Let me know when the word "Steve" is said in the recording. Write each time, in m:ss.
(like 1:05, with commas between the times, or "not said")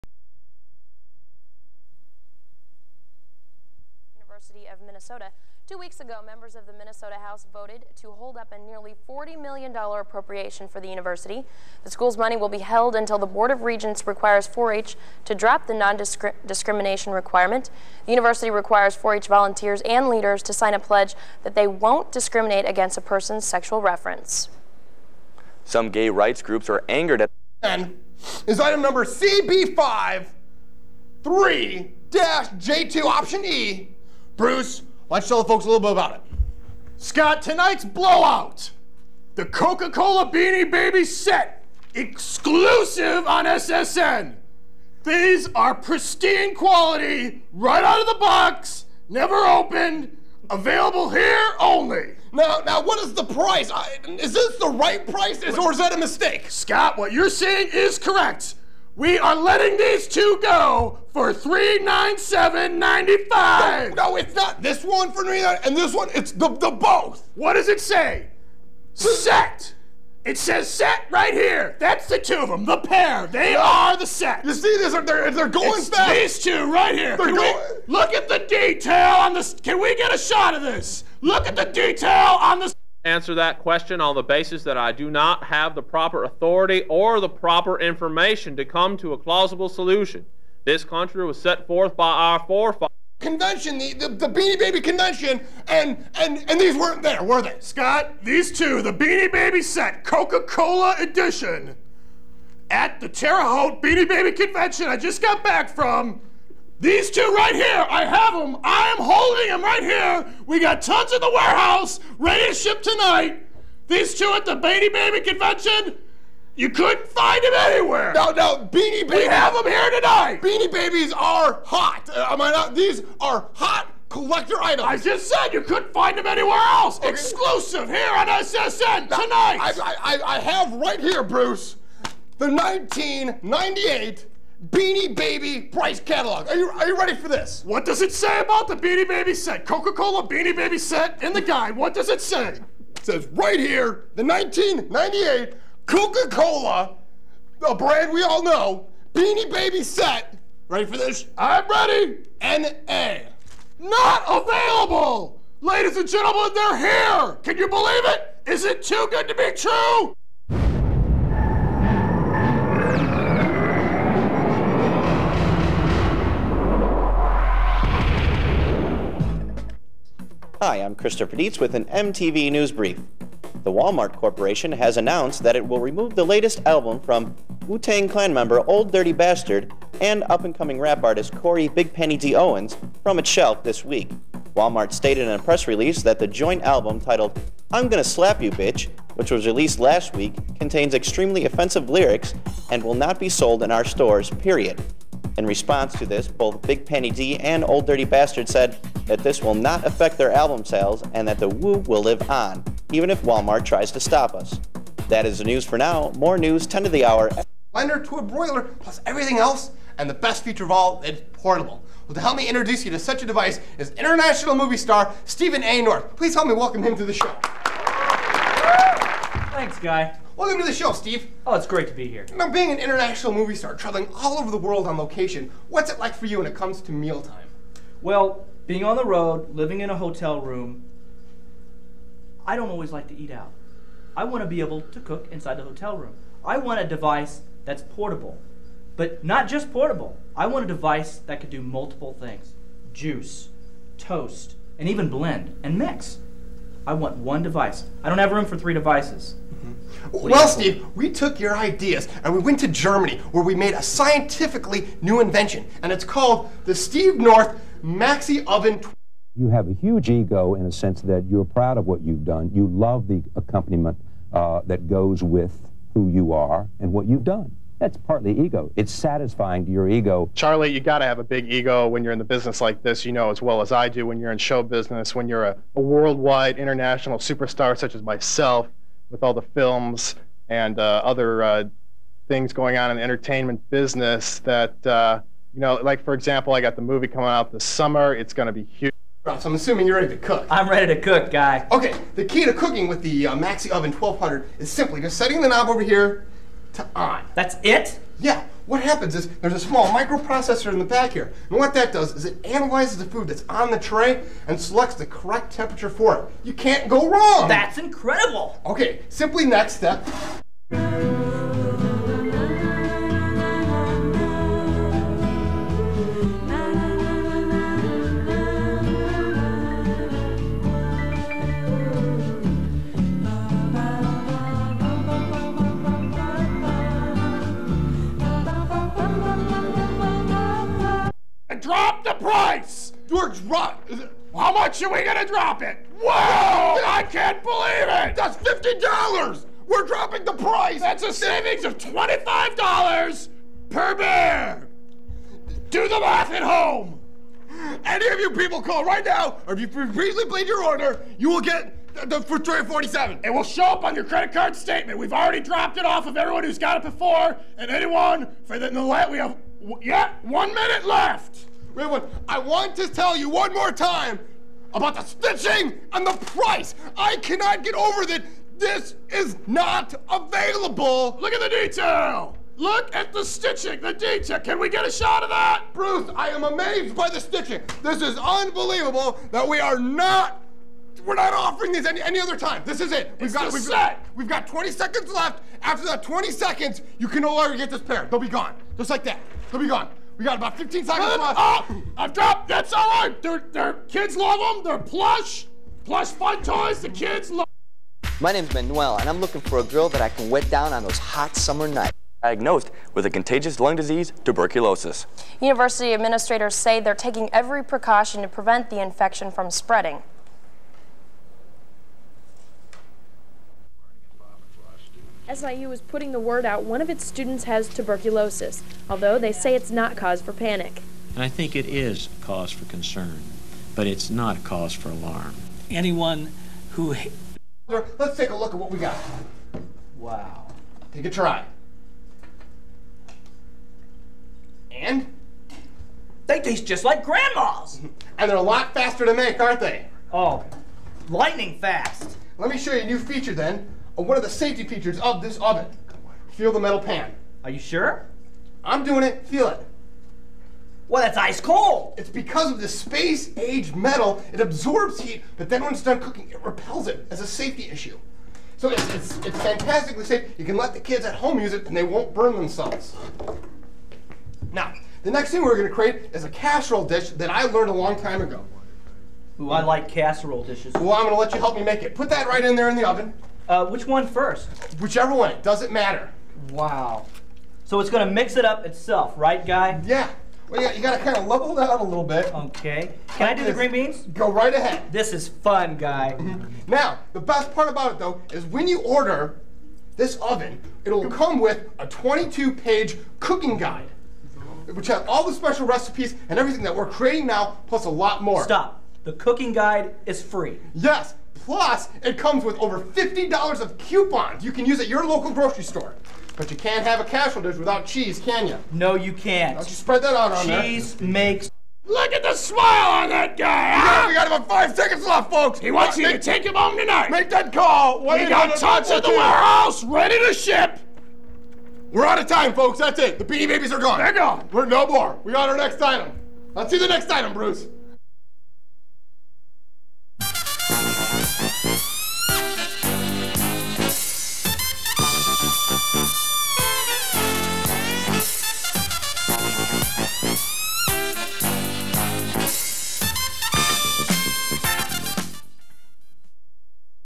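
3:40, 4:10, 4:16.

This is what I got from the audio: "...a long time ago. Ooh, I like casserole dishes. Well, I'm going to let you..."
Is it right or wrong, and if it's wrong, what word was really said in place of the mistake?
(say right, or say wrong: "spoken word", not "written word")
right.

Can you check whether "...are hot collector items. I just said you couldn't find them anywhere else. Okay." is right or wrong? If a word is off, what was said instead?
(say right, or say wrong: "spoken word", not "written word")
right.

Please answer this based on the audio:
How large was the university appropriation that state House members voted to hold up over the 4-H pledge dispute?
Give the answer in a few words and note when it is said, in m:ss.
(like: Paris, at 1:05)
$40 million, at 0:09.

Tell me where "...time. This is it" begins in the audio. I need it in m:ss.
6:22.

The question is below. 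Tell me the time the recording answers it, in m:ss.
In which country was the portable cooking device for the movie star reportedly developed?
4:12.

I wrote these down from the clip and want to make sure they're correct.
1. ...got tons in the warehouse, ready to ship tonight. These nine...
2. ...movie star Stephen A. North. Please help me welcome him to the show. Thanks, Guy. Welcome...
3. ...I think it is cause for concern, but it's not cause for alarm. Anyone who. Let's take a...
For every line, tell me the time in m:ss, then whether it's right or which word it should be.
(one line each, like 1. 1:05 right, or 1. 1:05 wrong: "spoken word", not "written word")
1. 1:50 wrong: "two", not "nine"
2. 3:34 right
3. 7:01 right.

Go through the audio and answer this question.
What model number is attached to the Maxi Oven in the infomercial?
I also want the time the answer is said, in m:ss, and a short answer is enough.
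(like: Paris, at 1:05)
1200, at 4:53.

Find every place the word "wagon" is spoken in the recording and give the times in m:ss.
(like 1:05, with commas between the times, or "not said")
not said.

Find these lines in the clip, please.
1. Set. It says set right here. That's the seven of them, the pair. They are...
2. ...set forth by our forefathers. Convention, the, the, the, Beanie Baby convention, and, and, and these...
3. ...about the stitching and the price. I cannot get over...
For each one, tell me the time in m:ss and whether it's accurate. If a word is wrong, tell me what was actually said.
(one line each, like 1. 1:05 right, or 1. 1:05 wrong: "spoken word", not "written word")
1. 1:08 wrong: "two", not "seven"
2. 1:31 right
3. 6:04 right.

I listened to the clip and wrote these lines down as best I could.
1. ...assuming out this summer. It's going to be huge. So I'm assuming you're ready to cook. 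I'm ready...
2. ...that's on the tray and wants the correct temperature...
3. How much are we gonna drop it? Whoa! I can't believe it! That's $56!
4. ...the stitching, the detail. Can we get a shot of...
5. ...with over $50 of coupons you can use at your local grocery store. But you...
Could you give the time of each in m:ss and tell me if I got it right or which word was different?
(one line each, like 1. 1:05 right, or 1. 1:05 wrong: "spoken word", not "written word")
1. 4:47 wrong: "coming", not "assuming"
2. 5:03 wrong: "selects", not "wants"
3. 5:34 wrong: "50", not "56"
4. 6:13 right
5. 8:22 right.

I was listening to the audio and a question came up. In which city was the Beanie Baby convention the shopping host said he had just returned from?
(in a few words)
Terre Haute.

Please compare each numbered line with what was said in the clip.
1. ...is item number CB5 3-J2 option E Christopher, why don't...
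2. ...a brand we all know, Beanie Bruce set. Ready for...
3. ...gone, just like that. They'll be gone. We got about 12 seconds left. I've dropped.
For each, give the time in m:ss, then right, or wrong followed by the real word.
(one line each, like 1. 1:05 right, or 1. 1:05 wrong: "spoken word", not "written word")
1. 0:28 wrong: "Bruce", not "Christopher"
2. 2:27 wrong: "Baby", not "Bruce"
3. 6:28 wrong: "15", not "12".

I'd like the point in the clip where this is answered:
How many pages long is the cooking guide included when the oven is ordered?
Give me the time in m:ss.
8:11.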